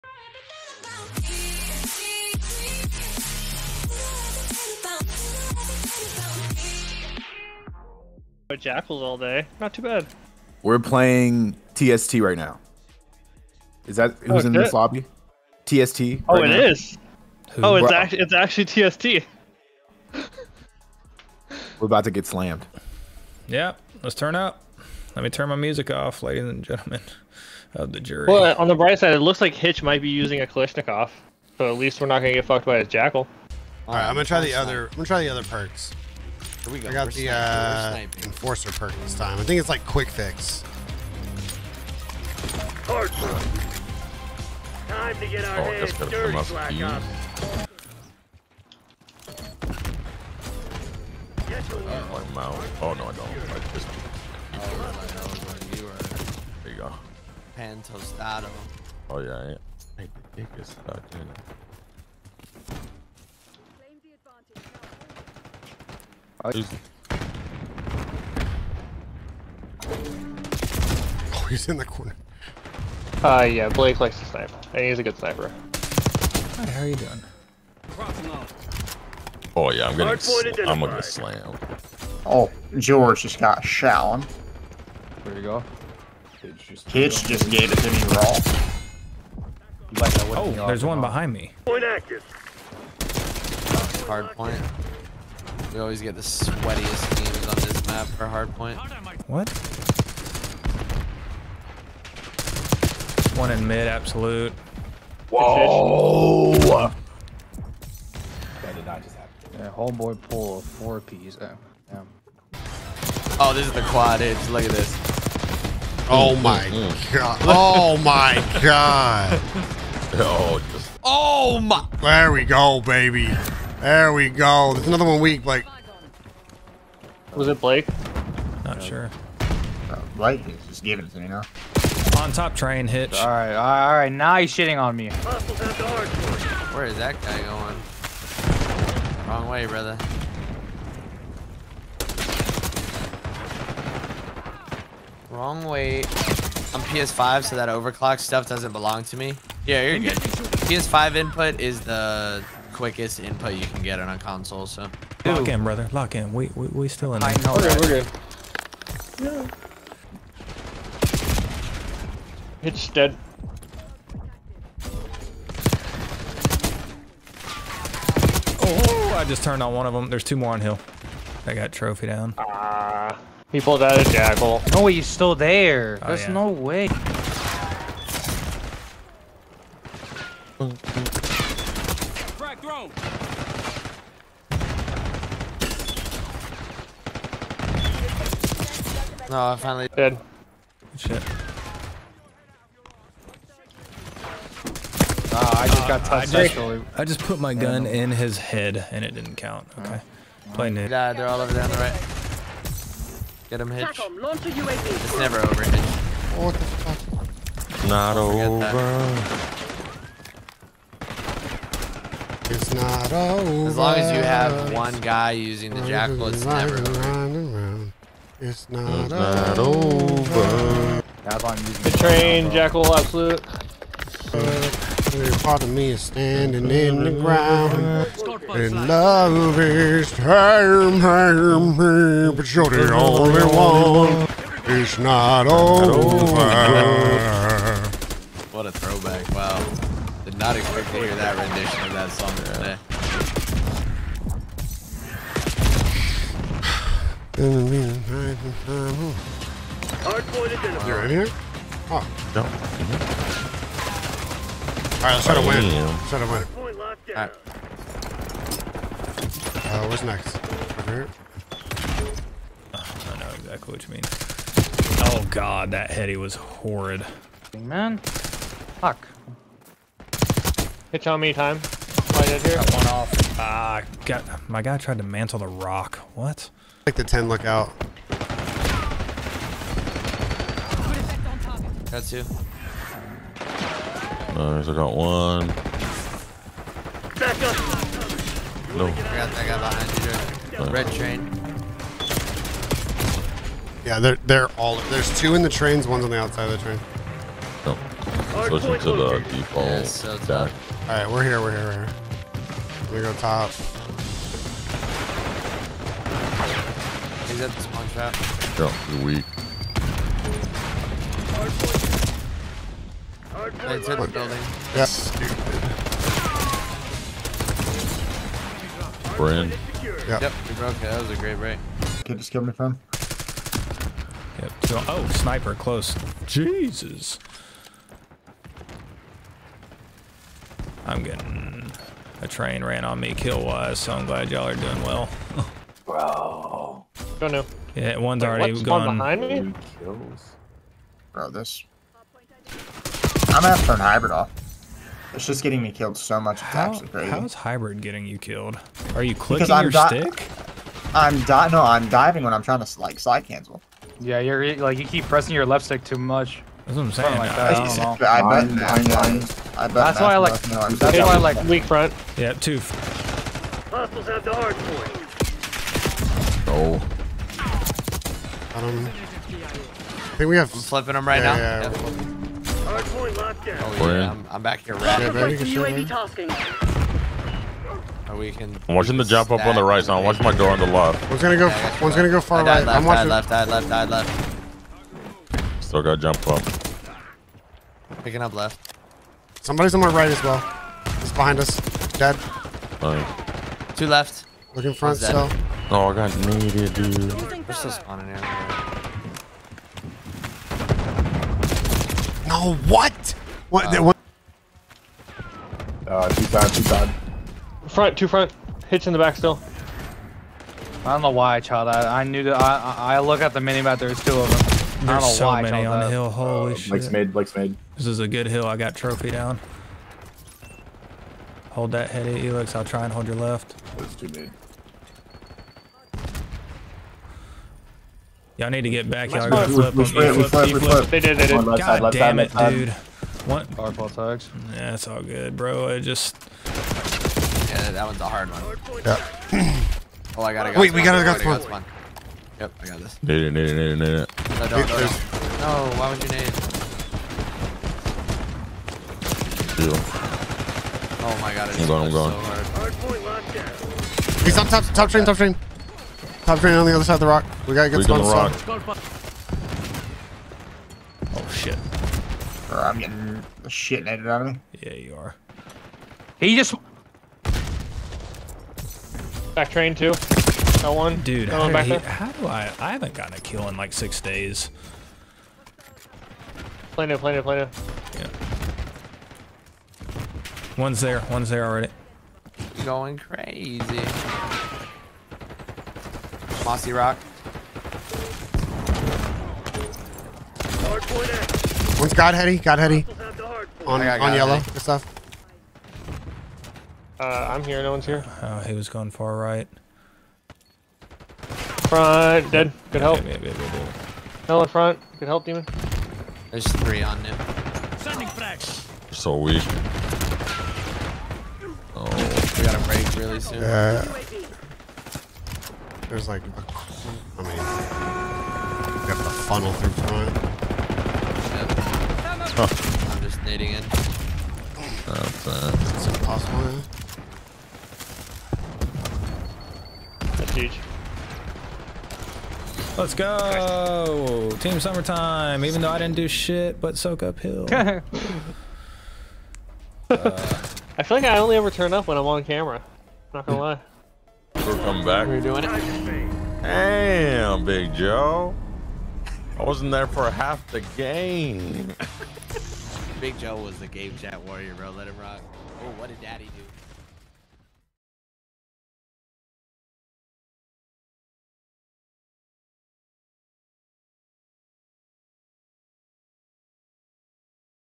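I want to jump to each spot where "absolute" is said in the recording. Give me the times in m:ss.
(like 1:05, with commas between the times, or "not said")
1:43, 3:42.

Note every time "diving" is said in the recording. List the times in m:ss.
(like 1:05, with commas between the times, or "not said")
5:51.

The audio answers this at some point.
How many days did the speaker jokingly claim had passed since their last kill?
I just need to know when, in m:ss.
7:53.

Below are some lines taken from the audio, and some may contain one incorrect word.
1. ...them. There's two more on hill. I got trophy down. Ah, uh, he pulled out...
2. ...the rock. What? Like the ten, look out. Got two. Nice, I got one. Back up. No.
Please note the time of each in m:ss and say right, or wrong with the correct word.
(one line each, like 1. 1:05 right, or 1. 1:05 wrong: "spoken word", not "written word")
1. 2:49 right
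2. 4:35 right.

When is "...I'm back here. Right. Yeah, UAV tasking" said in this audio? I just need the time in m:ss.
6:14.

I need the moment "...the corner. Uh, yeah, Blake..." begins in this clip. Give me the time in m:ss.
1:11.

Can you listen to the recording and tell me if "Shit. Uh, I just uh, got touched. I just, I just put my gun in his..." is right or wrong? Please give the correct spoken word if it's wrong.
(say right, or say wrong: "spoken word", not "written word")
right.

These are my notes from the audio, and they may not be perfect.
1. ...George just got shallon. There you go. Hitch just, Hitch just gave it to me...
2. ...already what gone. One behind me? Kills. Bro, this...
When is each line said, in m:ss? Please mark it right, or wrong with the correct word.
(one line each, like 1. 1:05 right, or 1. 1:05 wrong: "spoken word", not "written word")
1. 1:22 right
2. 5:38 right.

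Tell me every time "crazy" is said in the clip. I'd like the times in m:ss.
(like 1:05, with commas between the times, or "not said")
5:46, 8:02.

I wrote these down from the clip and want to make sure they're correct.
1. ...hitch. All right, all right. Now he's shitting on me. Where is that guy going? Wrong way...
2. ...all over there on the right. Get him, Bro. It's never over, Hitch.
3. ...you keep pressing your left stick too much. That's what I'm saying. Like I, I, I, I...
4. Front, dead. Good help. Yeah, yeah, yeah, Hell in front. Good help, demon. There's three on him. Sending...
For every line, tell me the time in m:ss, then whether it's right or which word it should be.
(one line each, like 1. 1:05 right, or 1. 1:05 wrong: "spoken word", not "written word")
1. 2:12 right
2. 3:21 wrong: "Hitch", not "Bro"
3. 5:54 right
4. 8:21 right.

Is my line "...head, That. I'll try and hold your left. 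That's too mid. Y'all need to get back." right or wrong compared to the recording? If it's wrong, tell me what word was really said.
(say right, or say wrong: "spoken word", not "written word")
wrong: "Elix", not "That".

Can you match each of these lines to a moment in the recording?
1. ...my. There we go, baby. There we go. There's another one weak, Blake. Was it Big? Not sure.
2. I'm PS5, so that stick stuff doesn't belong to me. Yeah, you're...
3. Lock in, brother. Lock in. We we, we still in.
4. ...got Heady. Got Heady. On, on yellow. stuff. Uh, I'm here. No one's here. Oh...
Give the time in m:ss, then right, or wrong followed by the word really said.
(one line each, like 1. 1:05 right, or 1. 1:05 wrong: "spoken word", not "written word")
1. 2:01 wrong: "Blake", not "Big"
2. 2:26 wrong: "overclock", not "stick"
3. 2:35 right
4. 8:11 right.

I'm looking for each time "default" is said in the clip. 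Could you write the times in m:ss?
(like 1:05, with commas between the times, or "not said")
4:59.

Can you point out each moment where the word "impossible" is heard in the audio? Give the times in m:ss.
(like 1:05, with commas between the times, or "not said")
8:45.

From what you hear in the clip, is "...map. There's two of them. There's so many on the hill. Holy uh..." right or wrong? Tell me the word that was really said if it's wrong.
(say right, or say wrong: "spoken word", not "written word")
right.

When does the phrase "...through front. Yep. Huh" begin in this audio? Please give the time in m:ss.
8:39.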